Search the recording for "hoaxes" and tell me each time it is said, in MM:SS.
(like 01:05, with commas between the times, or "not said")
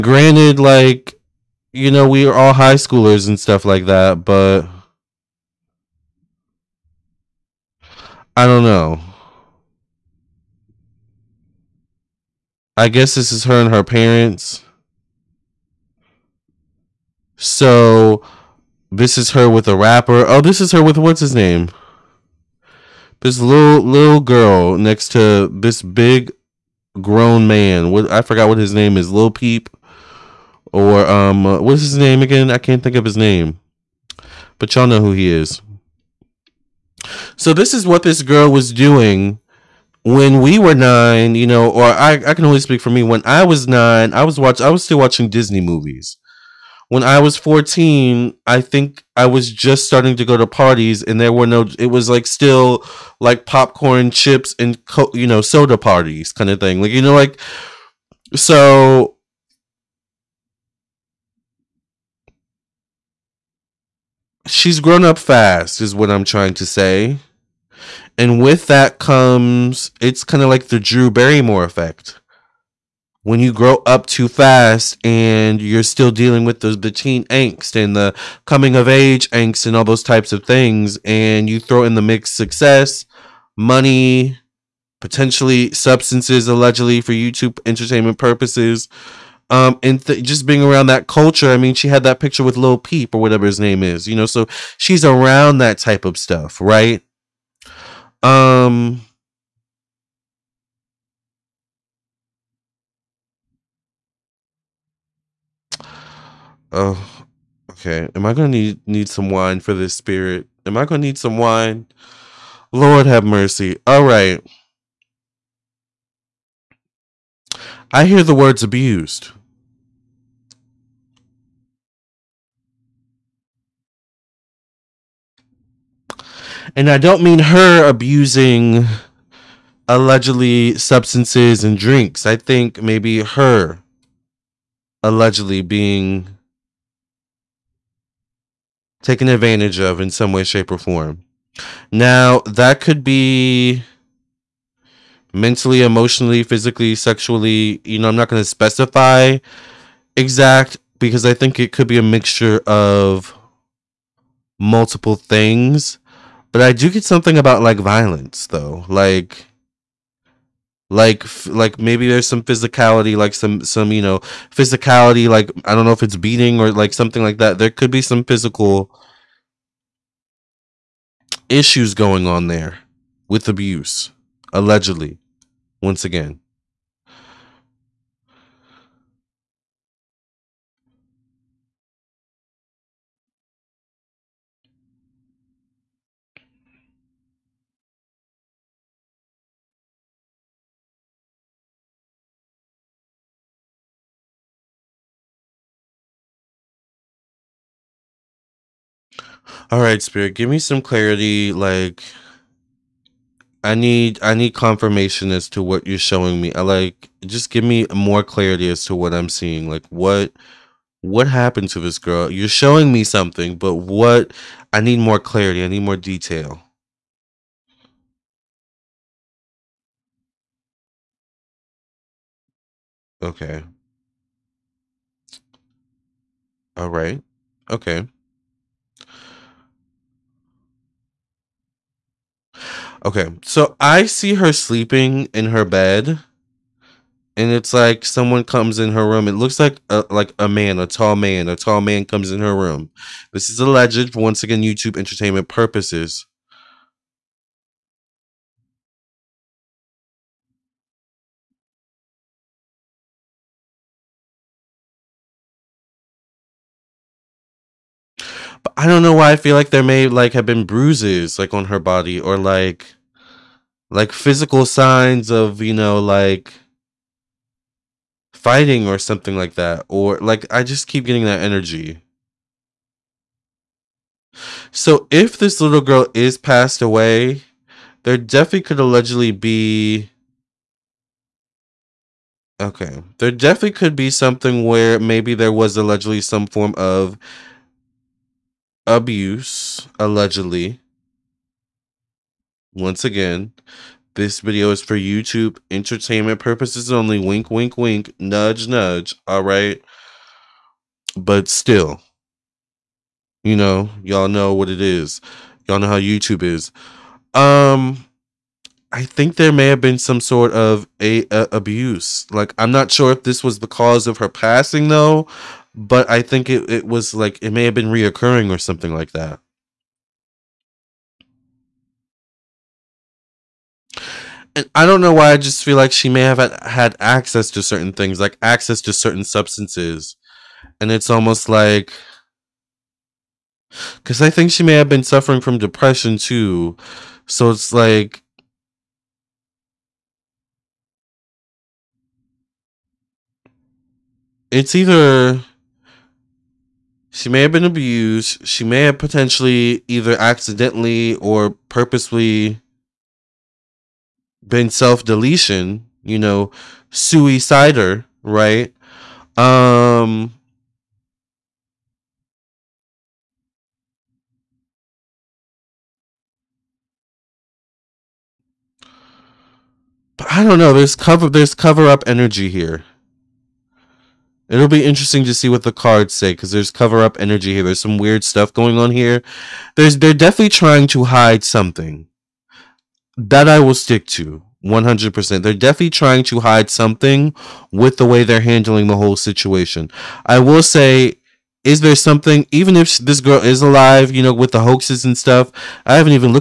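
06:34.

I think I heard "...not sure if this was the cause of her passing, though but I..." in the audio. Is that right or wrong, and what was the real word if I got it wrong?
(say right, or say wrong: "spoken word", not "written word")
right.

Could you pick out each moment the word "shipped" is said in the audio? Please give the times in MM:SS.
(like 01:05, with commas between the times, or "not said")
not said.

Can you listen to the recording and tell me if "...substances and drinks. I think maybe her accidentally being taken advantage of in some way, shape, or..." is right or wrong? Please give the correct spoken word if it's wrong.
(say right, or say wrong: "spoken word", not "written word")
wrong: "allegedly", not "accidentally".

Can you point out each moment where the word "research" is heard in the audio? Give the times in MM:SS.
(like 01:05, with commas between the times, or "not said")
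not said.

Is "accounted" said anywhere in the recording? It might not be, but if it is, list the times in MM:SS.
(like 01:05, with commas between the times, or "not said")
not said.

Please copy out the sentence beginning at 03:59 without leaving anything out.
It looks like a, like a man, a tall man, a tall man comes in her room.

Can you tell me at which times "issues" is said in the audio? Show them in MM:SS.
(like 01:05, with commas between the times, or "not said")
02:51.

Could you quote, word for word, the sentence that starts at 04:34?
So if this little girl is passed away, there definitely could allegedly be Okay.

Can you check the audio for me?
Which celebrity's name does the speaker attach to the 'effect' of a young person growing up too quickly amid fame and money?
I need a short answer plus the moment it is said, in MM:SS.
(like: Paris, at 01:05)
Drew Barrymore, at 01:10.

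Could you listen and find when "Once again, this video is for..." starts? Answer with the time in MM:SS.
04:52.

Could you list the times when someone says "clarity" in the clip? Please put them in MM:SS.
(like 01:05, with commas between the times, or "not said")
03:20, 03:28, 03:35.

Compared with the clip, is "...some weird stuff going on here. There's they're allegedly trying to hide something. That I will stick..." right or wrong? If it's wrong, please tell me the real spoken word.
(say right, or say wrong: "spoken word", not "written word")
wrong: "definitely", not "allegedly".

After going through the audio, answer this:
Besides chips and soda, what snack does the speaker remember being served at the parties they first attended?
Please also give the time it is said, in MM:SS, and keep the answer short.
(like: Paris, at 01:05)
Popcorn, at 00:53.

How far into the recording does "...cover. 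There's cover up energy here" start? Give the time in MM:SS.
06:10.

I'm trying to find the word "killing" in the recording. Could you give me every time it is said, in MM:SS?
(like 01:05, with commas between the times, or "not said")
not said.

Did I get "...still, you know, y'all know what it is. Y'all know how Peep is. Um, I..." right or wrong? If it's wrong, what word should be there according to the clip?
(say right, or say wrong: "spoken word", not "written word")
wrong: "YouTube", not "Peep".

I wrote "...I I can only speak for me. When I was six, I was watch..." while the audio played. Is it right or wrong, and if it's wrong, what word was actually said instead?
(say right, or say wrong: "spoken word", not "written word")
wrong: "nine", not "six".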